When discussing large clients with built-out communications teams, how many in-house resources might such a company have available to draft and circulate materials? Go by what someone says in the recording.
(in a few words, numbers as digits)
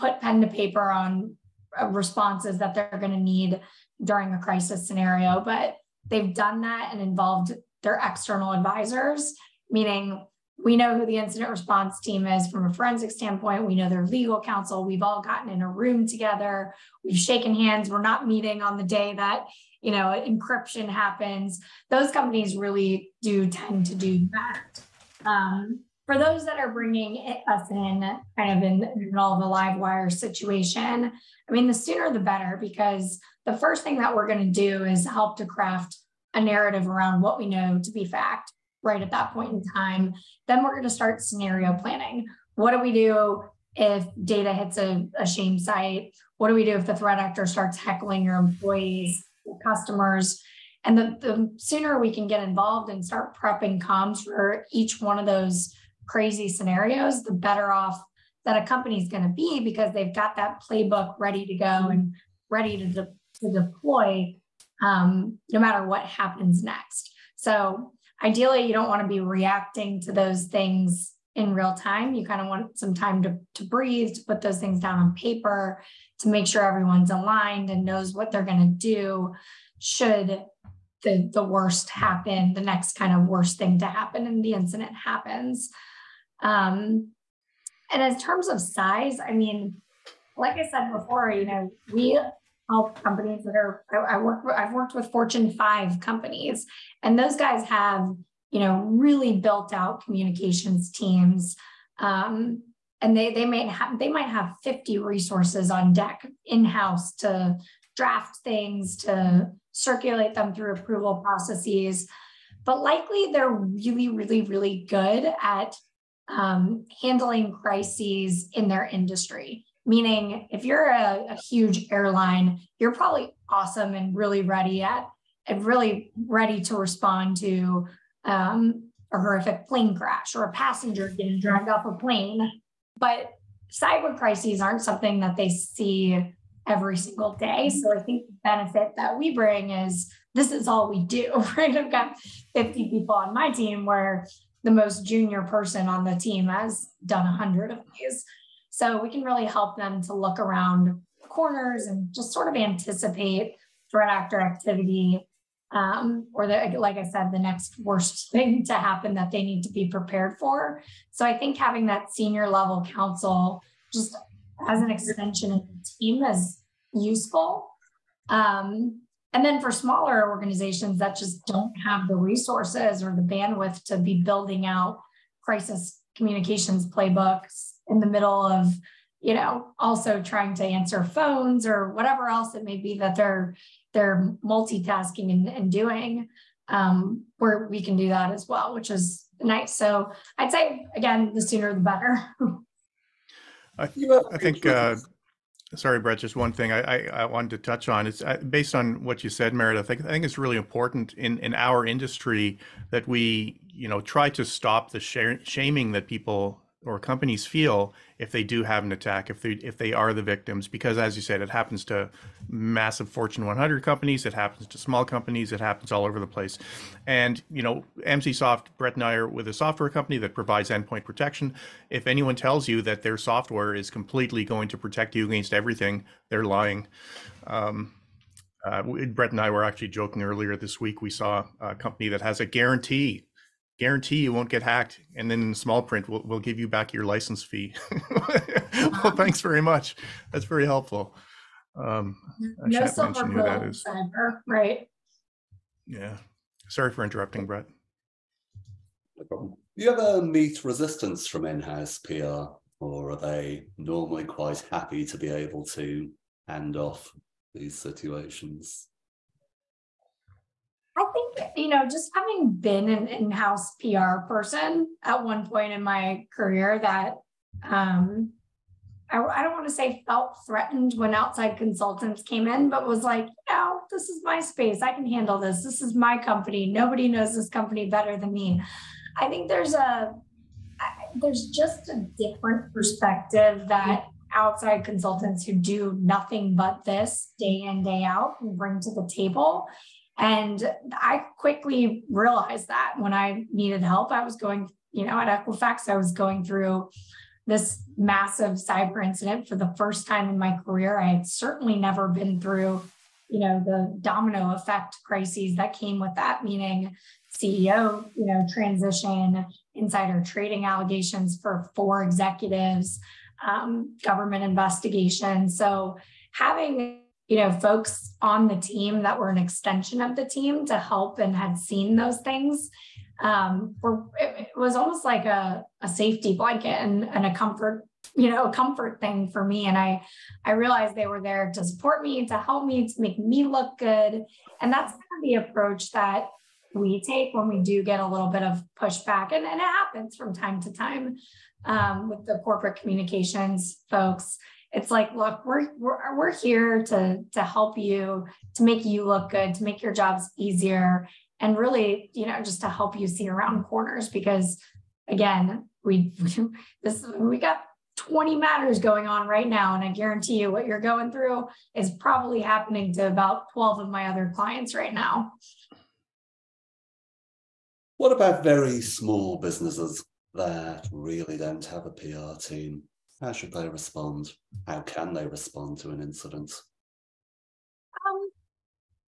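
50.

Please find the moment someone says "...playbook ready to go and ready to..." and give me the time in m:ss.
1:00.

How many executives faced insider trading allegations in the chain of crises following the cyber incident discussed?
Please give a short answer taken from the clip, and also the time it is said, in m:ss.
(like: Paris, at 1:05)
4, at 5:11.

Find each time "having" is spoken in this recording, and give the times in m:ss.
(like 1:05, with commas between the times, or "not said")
2:41, 4:22, 5:16.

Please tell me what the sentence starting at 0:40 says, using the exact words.
Then we're going to start scenario planning.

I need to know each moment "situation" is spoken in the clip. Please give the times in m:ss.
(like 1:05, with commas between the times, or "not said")
0:30, 4:17.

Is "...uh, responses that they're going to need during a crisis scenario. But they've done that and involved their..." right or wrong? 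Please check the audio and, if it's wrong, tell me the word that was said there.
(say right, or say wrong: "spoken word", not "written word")
right.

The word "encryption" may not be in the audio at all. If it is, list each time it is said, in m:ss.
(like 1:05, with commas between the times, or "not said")
0:20.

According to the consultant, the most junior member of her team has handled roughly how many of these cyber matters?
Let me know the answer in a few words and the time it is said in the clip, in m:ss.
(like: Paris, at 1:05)
100, at 2:27.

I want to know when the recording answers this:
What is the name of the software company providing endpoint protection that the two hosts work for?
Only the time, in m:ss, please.
3:38.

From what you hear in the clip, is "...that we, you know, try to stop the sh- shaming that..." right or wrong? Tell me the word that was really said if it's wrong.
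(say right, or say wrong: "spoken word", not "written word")
right.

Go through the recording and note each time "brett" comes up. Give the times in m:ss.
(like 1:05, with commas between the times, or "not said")
3:15, 3:38, 3:48, 4:07.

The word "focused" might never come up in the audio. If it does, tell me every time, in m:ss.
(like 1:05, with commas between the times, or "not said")
not said.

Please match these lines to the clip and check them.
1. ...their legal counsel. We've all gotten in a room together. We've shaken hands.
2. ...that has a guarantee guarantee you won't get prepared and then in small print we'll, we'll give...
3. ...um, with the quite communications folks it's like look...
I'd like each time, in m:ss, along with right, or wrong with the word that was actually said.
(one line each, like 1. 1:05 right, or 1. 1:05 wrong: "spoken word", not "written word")
1. 0:13 right
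2. 3:52 wrong: "hacked", not "prepared"
3. 5:41 wrong: "corporate", not "quite".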